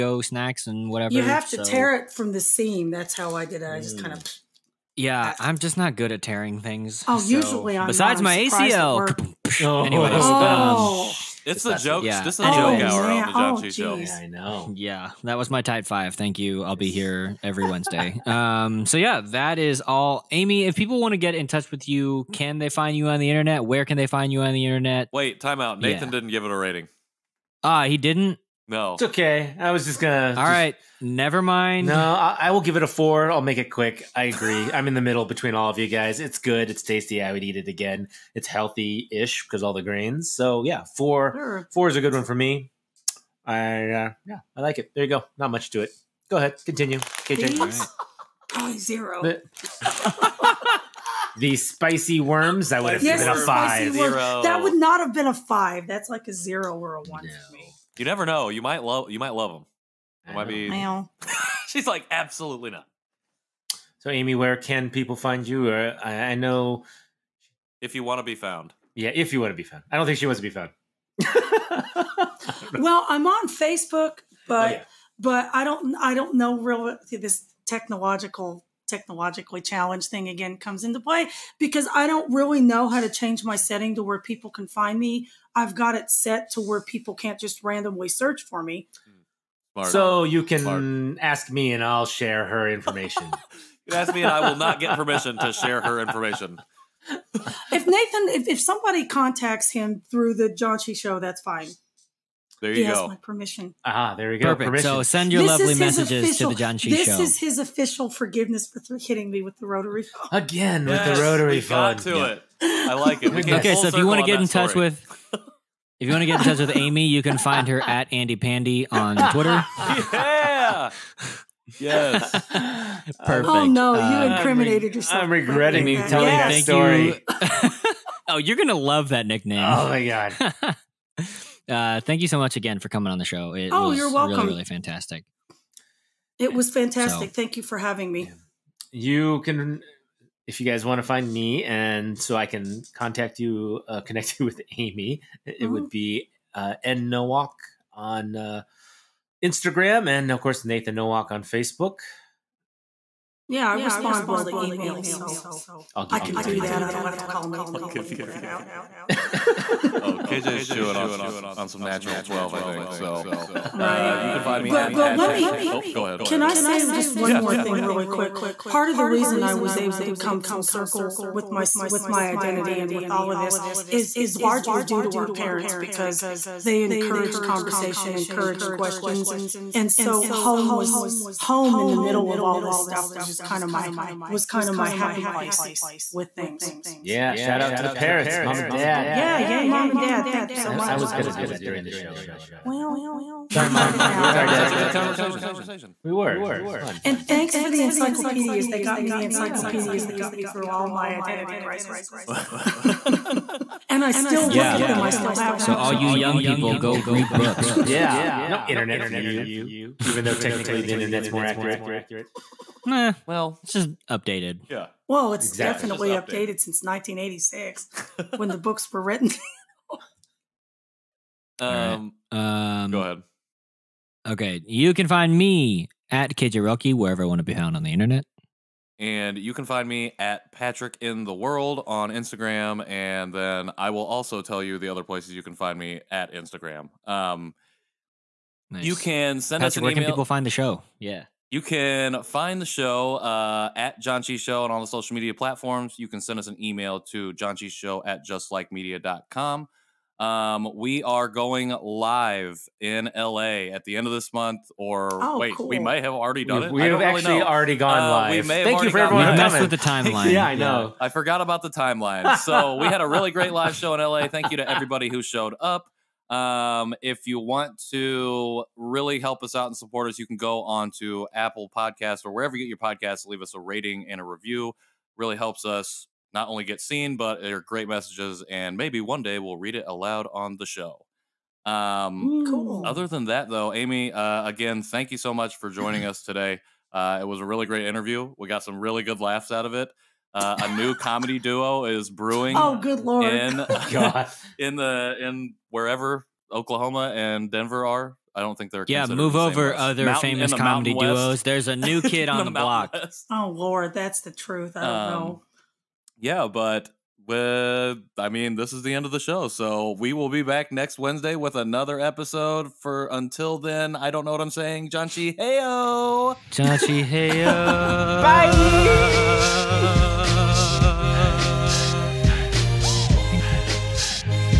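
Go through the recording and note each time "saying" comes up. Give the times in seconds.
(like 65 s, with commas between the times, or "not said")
314 s.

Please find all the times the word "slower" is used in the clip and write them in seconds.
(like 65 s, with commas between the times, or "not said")
not said.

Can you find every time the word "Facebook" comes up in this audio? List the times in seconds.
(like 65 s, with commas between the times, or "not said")
73 s, 151 s.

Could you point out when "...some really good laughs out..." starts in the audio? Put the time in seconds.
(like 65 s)
288 s.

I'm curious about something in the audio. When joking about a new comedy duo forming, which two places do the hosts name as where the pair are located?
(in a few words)
Oklahoma and Denver.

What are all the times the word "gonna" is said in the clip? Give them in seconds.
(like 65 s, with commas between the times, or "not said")
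30 s, 128 s.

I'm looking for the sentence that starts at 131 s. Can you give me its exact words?
Uh, thank you so much again for coming on the show.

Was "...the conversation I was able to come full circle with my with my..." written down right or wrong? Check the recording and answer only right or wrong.
wrong.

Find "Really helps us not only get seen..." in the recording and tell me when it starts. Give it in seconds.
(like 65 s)
275 s.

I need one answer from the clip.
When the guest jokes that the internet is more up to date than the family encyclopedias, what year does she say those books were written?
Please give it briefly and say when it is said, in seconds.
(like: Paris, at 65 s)
1986, at 216 s.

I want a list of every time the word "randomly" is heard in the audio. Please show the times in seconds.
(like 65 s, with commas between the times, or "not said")
87 s.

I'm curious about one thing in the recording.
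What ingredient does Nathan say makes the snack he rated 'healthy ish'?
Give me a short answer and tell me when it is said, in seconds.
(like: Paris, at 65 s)
grains, at 39 s.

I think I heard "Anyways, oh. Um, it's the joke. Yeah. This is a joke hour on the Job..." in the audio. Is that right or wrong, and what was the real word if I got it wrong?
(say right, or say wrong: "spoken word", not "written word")
right.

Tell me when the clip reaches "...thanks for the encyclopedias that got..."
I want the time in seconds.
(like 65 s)
197 s.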